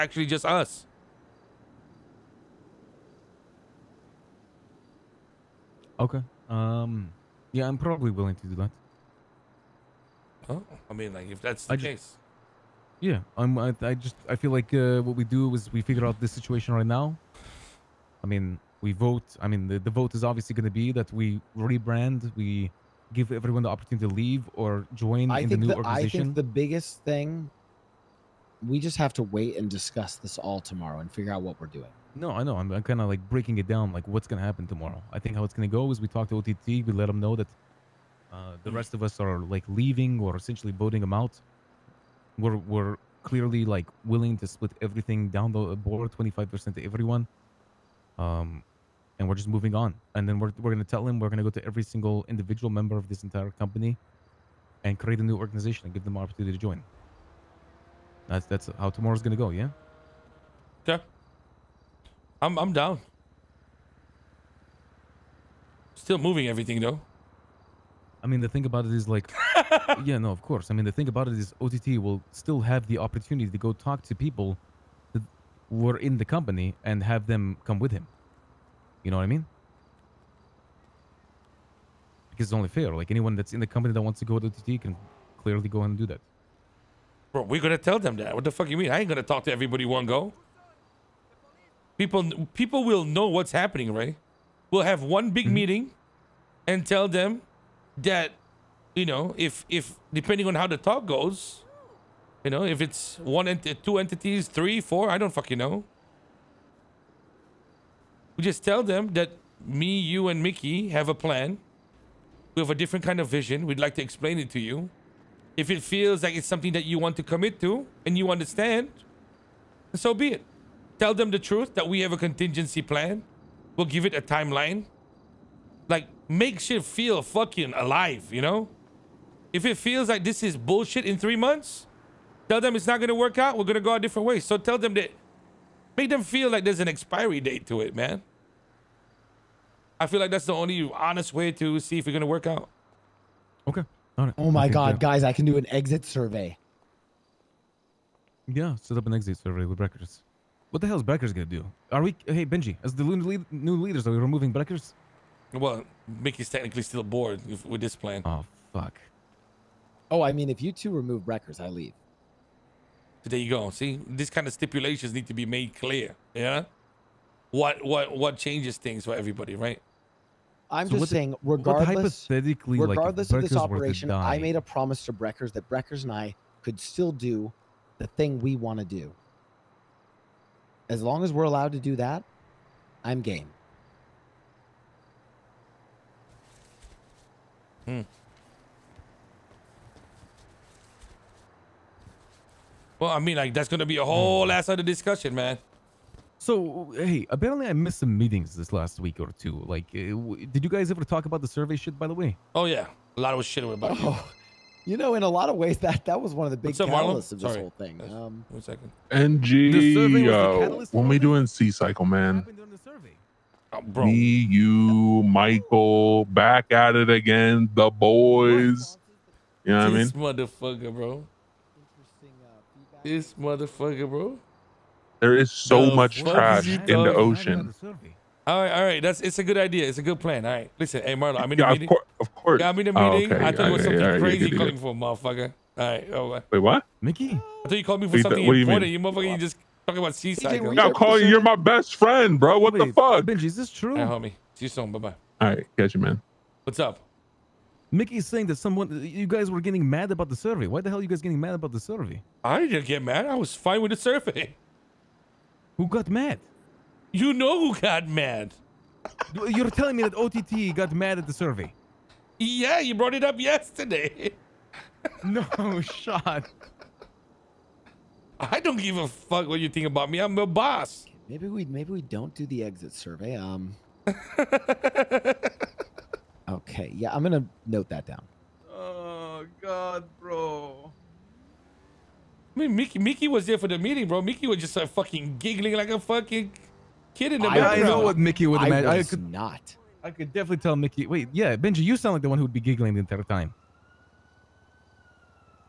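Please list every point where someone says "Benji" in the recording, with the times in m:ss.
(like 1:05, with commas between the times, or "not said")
2:32, 4:03, 4:51.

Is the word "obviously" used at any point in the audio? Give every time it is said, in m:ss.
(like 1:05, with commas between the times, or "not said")
0:20.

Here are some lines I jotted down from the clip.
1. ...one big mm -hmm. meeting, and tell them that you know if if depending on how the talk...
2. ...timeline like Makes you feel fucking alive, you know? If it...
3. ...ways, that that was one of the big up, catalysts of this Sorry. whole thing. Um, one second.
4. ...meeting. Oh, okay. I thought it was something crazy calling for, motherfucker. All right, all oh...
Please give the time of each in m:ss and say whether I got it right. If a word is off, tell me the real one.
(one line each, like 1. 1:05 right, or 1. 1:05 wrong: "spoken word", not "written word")
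1. 1:35 right
2. 2:04 right
3. 3:25 right
4. 3:52 right.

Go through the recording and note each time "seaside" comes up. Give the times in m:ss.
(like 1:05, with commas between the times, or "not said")
3:31, 4:00.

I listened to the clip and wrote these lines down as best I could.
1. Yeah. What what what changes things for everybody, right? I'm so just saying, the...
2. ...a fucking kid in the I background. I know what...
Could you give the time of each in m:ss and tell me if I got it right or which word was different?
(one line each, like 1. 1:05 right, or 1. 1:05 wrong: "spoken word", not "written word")
1. 2:46 right
2. 4:45 right.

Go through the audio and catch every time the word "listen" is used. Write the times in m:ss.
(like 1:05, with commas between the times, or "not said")
3:50.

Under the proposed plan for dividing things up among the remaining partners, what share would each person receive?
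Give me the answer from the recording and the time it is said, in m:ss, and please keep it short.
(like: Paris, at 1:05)
25%, at 0:46.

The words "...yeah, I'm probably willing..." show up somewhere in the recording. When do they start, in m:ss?
0:07.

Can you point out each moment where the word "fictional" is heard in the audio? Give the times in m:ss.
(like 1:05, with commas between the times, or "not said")
not said.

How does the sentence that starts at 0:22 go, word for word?
We give everyone the opportunity to leave or join I in the new the, organization.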